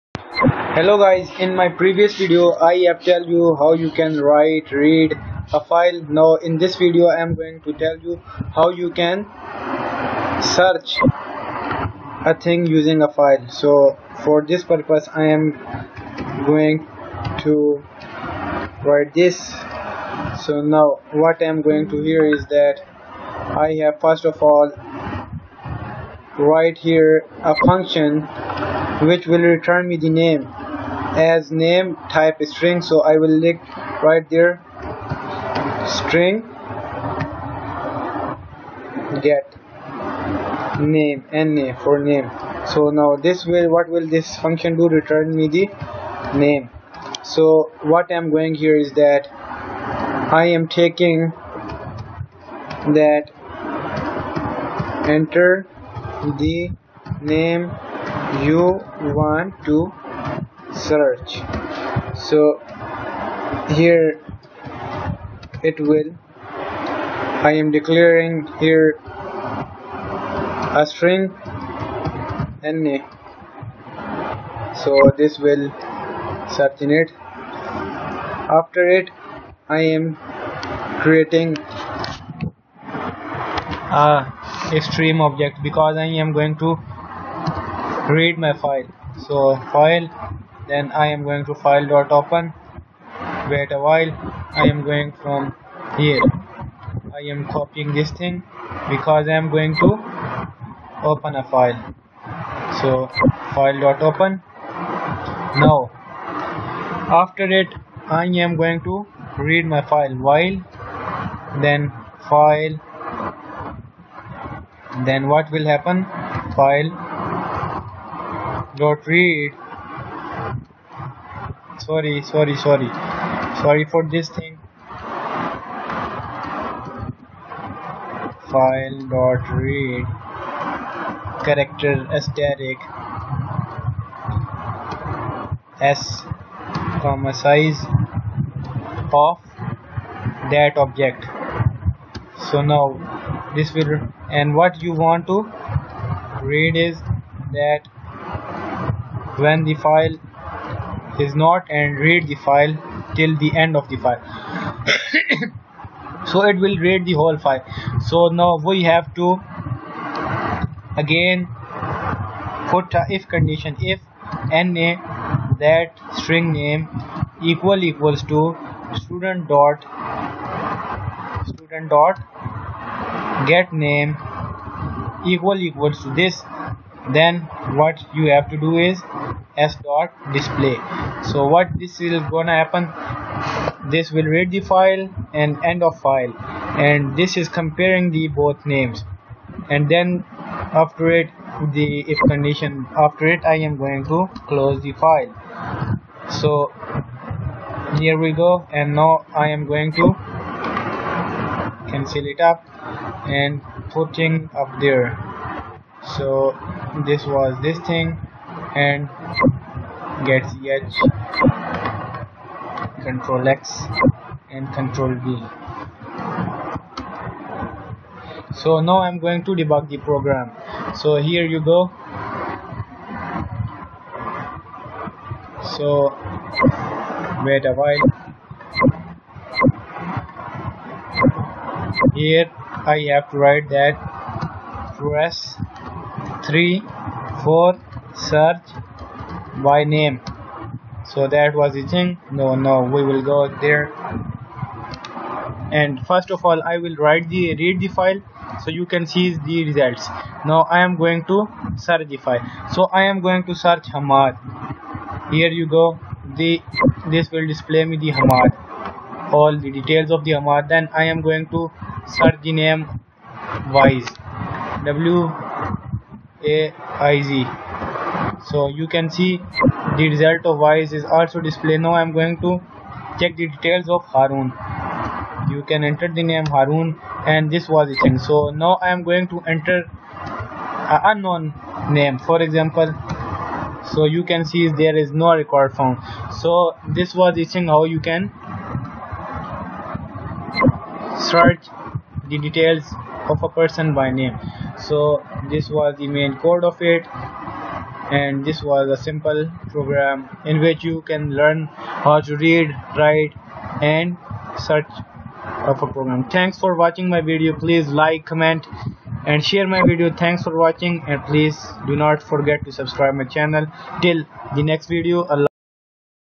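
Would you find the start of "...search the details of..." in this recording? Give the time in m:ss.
4:51.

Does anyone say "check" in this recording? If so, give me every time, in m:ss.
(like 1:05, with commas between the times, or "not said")
4:33.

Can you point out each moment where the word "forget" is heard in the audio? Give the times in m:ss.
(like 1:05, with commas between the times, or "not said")
5:12.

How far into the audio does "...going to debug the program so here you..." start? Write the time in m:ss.
3:39.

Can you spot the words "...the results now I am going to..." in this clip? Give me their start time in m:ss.
4:09.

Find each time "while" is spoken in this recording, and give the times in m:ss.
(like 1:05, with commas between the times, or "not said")
1:33, 1:50, 3:47.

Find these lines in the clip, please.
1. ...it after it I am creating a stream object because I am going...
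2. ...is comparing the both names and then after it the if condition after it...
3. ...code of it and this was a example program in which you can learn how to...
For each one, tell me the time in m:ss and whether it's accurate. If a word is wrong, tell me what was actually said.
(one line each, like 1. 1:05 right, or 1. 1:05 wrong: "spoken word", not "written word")
1. 1:16 right
2. 3:07 right
3. 4:56 wrong: "simple", not "example".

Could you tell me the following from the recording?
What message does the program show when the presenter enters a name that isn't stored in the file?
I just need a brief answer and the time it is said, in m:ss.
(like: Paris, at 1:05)
No record found, at 4:45.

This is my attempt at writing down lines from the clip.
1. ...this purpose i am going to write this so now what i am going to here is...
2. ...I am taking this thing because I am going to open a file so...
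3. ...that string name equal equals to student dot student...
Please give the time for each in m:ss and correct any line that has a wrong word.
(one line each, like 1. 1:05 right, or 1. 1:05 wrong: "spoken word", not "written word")
1. 0:14 right
2. 1:37 wrong: "copying", not "taking"
3. 2:45 right.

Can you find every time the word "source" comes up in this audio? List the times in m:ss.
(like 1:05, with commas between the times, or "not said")
not said.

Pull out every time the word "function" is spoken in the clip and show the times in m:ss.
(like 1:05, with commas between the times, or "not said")
0:27, 0:44.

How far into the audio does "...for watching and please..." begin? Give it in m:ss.
5:10.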